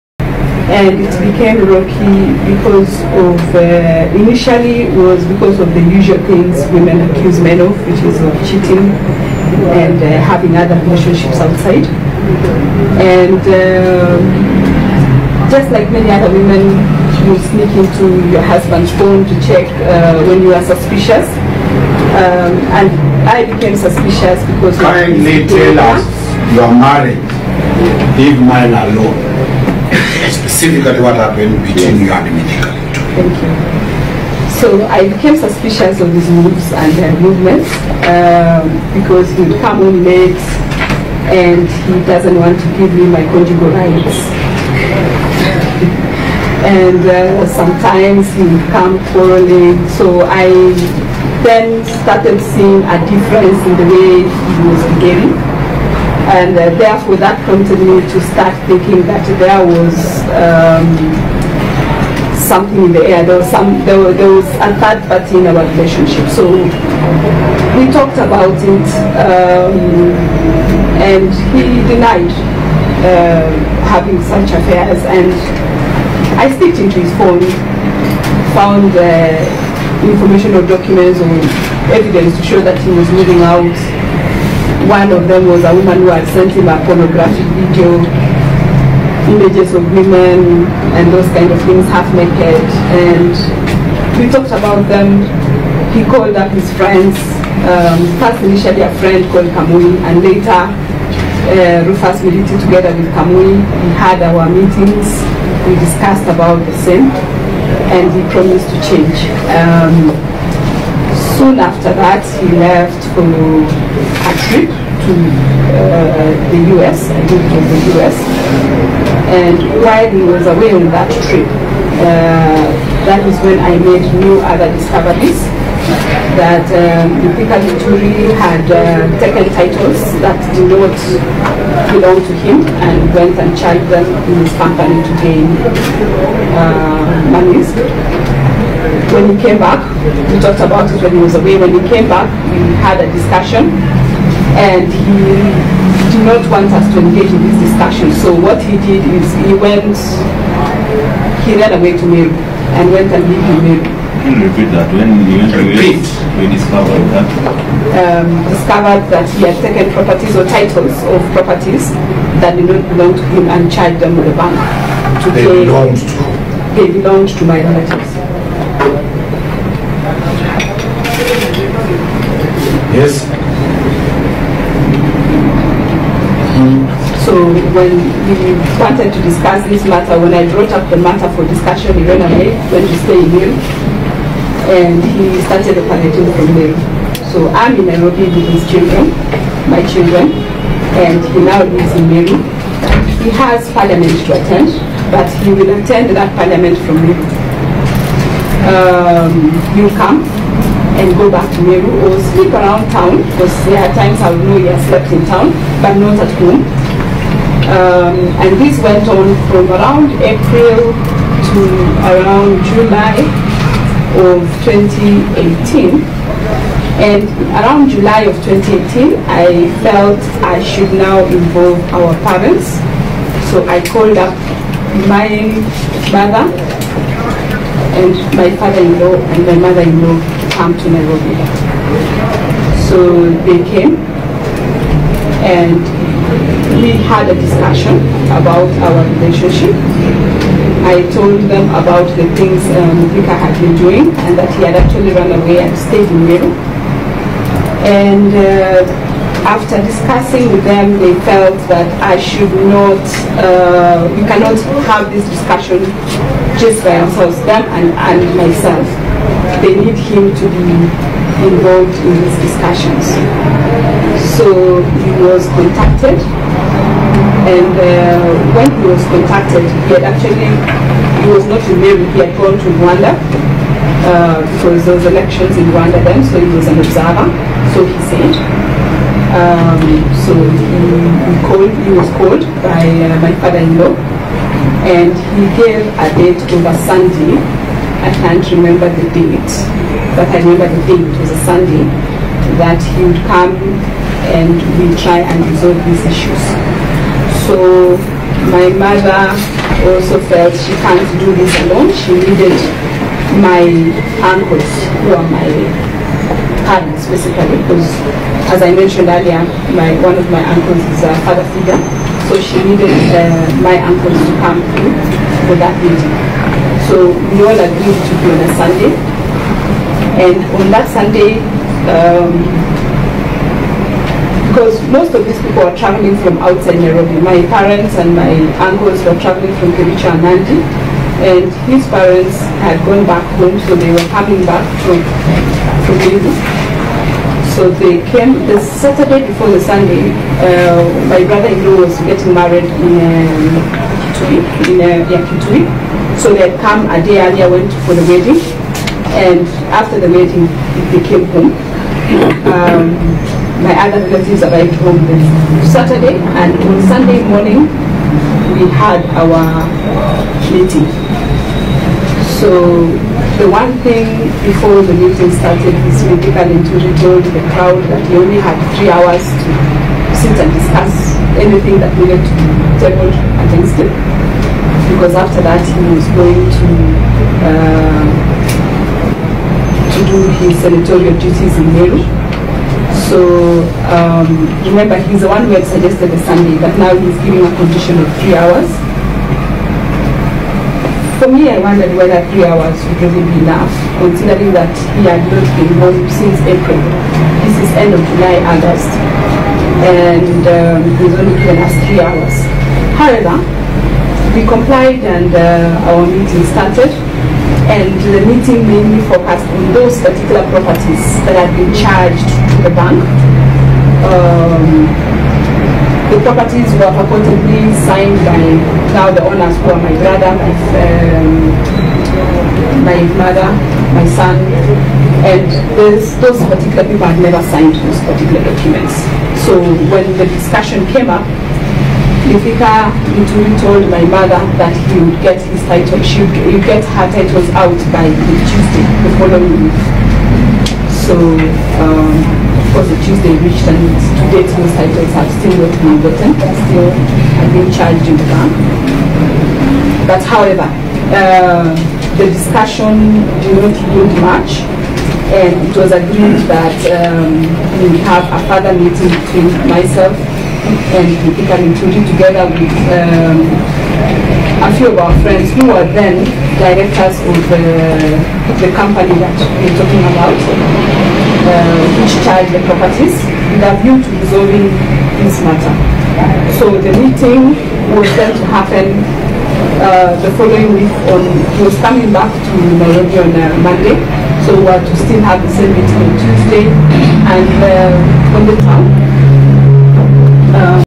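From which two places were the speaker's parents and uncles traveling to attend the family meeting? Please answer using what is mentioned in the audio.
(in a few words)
Kericho and Nandi.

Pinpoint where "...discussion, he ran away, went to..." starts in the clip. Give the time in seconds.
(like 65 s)
181 s.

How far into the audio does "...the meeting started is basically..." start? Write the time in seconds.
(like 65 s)
364 s.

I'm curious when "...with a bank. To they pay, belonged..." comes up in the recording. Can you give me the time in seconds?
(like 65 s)
164 s.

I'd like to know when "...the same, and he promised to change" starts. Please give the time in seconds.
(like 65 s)
106 s.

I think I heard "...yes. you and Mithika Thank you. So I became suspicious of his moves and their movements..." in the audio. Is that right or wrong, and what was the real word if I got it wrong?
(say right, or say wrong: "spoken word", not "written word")
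right.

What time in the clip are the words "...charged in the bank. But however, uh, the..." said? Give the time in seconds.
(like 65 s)
447 s.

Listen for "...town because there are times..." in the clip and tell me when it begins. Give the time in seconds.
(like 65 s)
202 s.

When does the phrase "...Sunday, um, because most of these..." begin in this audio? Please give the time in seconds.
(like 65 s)
320 s.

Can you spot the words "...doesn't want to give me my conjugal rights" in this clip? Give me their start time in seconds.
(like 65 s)
42 s.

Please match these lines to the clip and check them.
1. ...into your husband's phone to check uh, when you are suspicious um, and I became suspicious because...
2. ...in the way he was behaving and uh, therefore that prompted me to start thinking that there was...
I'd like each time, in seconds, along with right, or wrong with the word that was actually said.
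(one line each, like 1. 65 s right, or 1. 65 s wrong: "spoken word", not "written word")
1. 17 s right
2. 53 s right.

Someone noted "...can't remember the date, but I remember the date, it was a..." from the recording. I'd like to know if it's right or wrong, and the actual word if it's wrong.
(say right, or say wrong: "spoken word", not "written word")
right.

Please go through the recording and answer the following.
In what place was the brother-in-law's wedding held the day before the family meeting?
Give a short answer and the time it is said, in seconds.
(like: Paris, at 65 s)
Kitui, at 345 s.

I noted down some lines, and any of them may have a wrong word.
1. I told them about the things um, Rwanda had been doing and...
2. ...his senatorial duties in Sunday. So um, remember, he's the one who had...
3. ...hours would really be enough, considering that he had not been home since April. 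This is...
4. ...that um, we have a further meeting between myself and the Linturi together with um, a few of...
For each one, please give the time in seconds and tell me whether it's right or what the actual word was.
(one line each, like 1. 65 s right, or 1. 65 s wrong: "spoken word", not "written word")
1. 240 s wrong: "Vika", not "Rwanda"
2. 380 s wrong: "Meru", not "Sunday"
3. 392 s right
4. 456 s right.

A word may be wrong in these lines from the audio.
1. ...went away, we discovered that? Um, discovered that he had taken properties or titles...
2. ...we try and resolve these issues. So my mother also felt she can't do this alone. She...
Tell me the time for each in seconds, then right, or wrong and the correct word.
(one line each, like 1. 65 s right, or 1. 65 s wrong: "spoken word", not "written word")
1. 155 s right
2. 294 s right.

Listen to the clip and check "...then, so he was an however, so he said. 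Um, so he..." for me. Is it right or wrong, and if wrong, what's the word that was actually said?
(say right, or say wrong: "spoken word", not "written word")
wrong: "observer", not "however".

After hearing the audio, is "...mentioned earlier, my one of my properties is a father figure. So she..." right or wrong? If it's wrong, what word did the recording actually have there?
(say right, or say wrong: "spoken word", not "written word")
wrong: "uncles", not "properties".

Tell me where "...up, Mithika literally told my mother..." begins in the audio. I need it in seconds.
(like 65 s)
431 s.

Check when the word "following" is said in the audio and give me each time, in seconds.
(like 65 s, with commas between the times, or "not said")
439 s, 480 s.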